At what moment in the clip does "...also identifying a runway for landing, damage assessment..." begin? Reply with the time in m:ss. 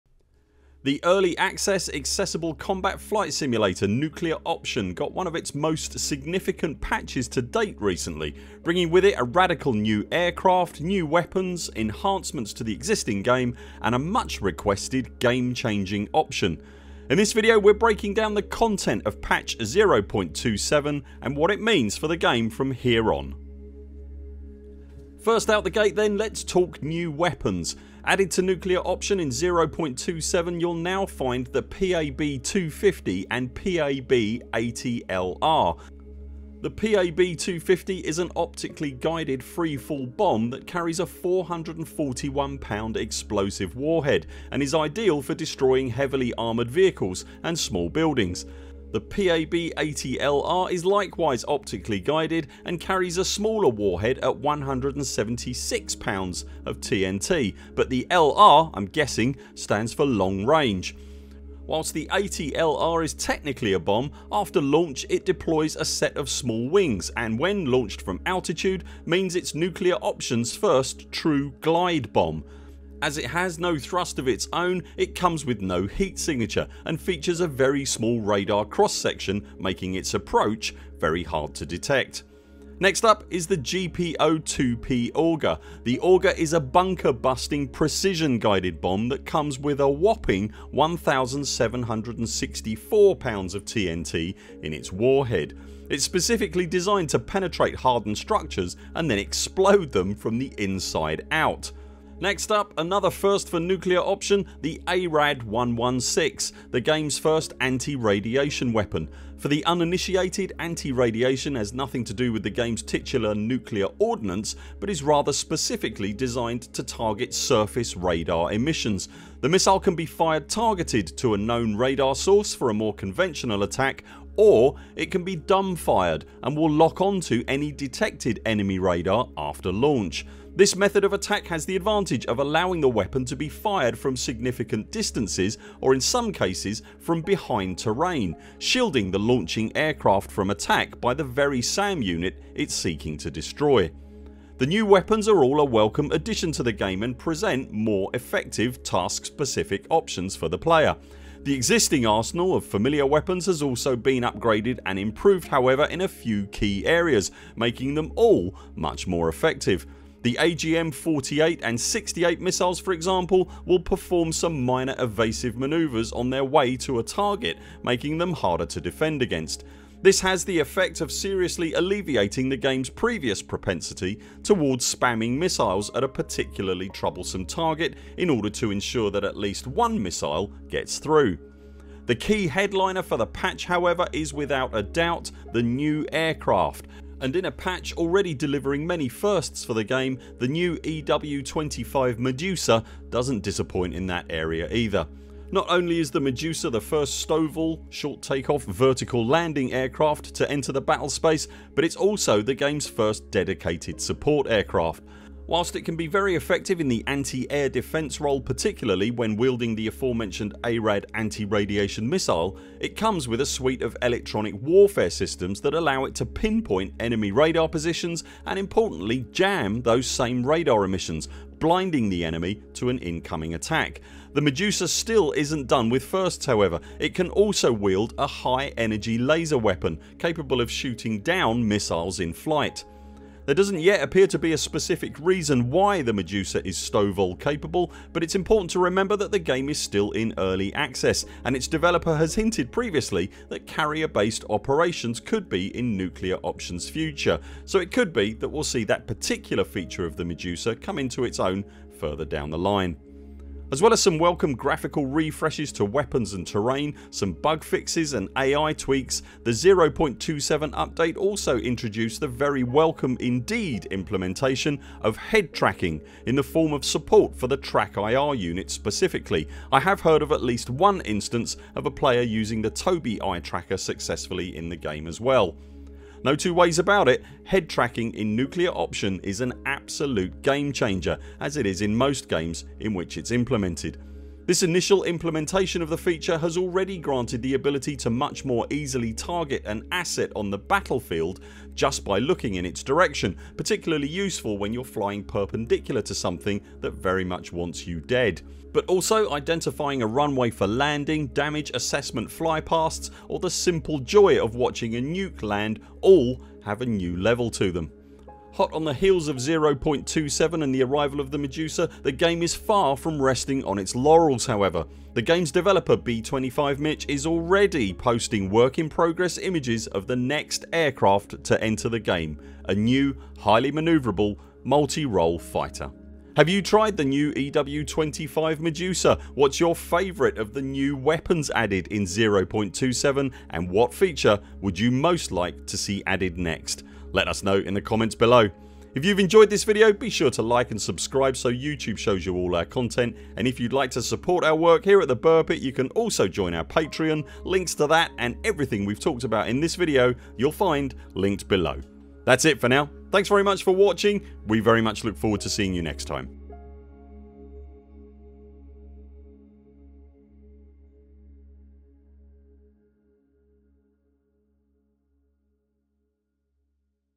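4:58.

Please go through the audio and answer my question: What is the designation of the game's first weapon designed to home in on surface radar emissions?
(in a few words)
ARAD 116.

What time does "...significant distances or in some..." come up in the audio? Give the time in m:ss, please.
2:14.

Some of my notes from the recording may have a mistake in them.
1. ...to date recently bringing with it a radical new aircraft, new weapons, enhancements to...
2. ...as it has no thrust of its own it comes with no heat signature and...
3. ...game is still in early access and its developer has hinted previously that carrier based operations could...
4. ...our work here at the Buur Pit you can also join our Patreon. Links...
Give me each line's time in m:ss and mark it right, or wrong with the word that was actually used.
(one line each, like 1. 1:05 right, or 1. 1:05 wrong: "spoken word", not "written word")
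1. 0:07 right
2. 1:13 right
3. 3:59 right
4. 5:44 right.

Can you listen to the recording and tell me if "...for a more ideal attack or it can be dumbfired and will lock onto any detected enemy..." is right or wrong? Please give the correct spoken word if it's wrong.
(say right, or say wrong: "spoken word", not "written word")
wrong: "conventional", not "ideal".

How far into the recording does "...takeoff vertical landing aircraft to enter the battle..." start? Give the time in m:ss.
3:18.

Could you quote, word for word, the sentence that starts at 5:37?
Let us know in the comments below.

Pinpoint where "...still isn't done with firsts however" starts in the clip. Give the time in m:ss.
3:44.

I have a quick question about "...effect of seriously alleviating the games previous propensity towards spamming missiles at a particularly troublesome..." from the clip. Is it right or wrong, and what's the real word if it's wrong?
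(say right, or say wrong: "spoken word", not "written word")
right.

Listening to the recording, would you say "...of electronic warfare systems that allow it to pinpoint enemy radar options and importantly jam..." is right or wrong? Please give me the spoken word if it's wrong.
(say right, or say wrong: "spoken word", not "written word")
wrong: "positions", not "options".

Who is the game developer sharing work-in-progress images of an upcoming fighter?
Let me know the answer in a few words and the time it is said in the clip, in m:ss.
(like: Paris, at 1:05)
B25 Mitch, at 5:15.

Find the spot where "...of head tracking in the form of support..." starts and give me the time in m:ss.
4:25.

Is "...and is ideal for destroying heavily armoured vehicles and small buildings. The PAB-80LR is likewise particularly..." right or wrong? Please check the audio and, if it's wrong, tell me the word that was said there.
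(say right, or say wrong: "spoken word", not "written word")
wrong: "optically", not "particularly".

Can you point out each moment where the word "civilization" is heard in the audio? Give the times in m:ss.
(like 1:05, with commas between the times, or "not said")
not said.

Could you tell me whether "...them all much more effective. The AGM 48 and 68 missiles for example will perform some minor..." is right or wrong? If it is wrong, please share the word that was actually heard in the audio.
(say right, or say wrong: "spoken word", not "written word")
right.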